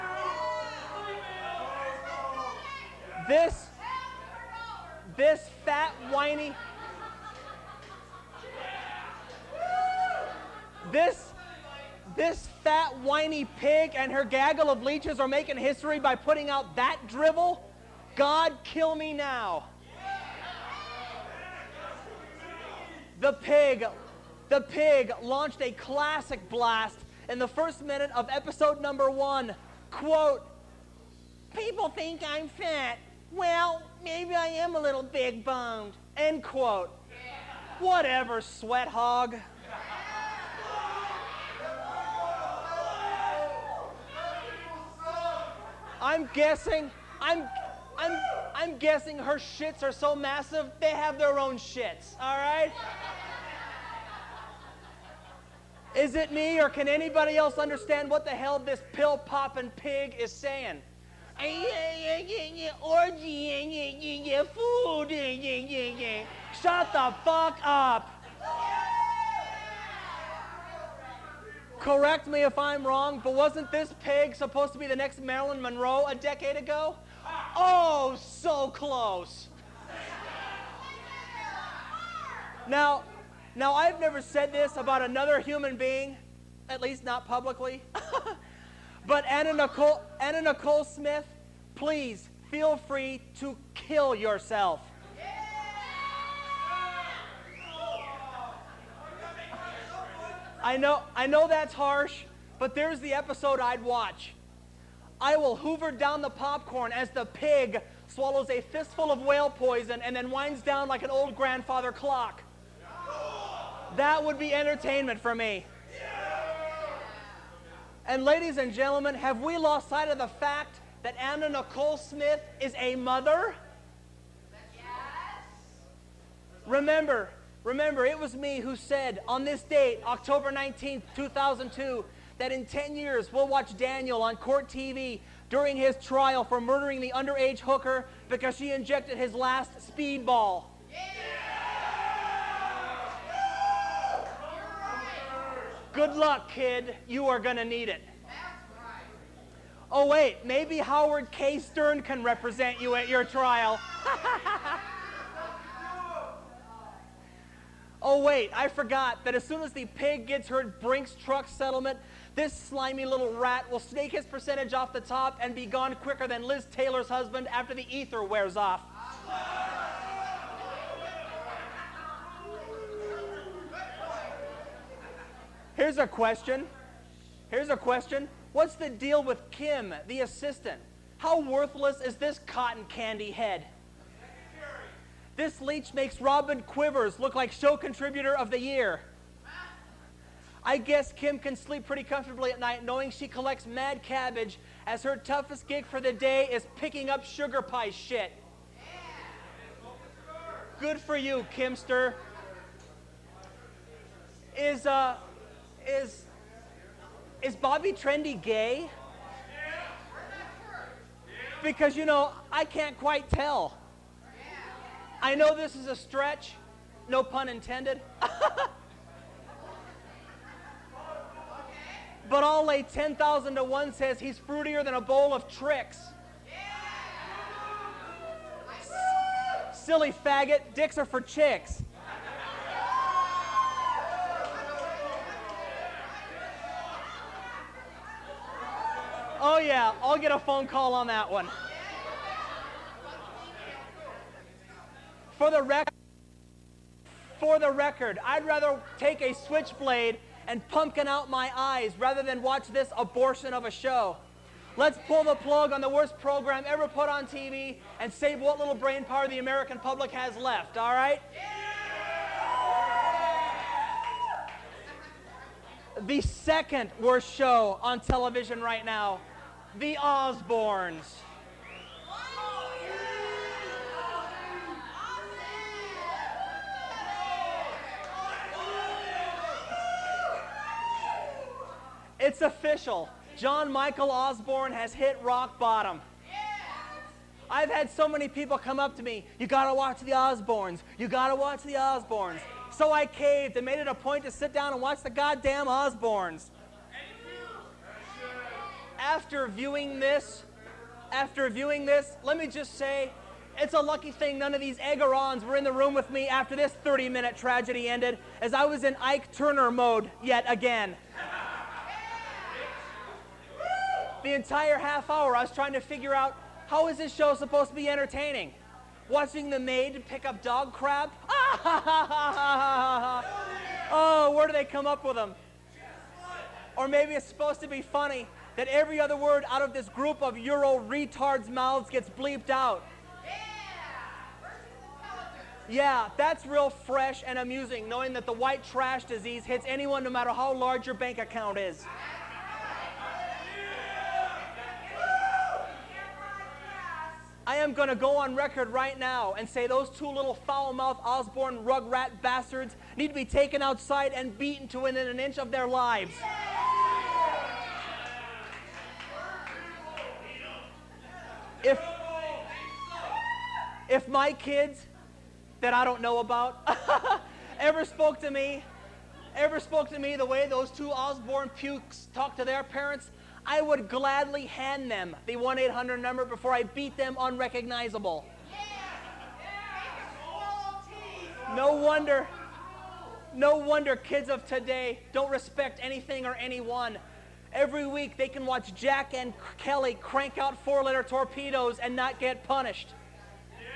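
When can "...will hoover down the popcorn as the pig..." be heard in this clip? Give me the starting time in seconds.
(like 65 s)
105 s.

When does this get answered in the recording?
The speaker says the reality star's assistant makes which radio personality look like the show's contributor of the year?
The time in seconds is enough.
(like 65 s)
186 s.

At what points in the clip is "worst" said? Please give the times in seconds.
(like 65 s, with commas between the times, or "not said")
255 s, 266 s.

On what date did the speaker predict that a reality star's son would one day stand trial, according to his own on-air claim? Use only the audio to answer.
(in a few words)
October 19th, 2002.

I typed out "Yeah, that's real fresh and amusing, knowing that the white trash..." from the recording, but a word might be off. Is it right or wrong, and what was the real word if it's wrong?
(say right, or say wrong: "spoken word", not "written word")
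right.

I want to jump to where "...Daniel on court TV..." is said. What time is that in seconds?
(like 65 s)
133 s.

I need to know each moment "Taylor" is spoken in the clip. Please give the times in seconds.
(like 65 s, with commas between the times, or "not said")
166 s.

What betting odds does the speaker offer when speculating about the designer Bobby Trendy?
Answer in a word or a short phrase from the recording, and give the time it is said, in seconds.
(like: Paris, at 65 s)
10,000 to 1, at 222 s.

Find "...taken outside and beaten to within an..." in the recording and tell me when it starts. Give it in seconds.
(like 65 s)
353 s.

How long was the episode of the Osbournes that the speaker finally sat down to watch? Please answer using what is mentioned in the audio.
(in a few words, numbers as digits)
30 minutes.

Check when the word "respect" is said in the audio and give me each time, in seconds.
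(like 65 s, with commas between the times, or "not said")
385 s.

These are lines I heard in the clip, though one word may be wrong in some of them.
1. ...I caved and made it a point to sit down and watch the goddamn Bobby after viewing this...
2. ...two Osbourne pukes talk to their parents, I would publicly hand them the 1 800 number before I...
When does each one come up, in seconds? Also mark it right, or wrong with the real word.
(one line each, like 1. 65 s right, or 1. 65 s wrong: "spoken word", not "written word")
1. 292 s wrong: "Osbournes", not "Bobby"
2. 370 s wrong: "gladly", not "publicly".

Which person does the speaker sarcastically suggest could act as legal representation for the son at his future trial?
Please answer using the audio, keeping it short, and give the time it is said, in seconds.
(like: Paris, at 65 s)
Howard K. Stern, at 150 s.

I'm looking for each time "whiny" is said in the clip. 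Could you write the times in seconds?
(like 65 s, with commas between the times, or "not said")
6 s, 12 s.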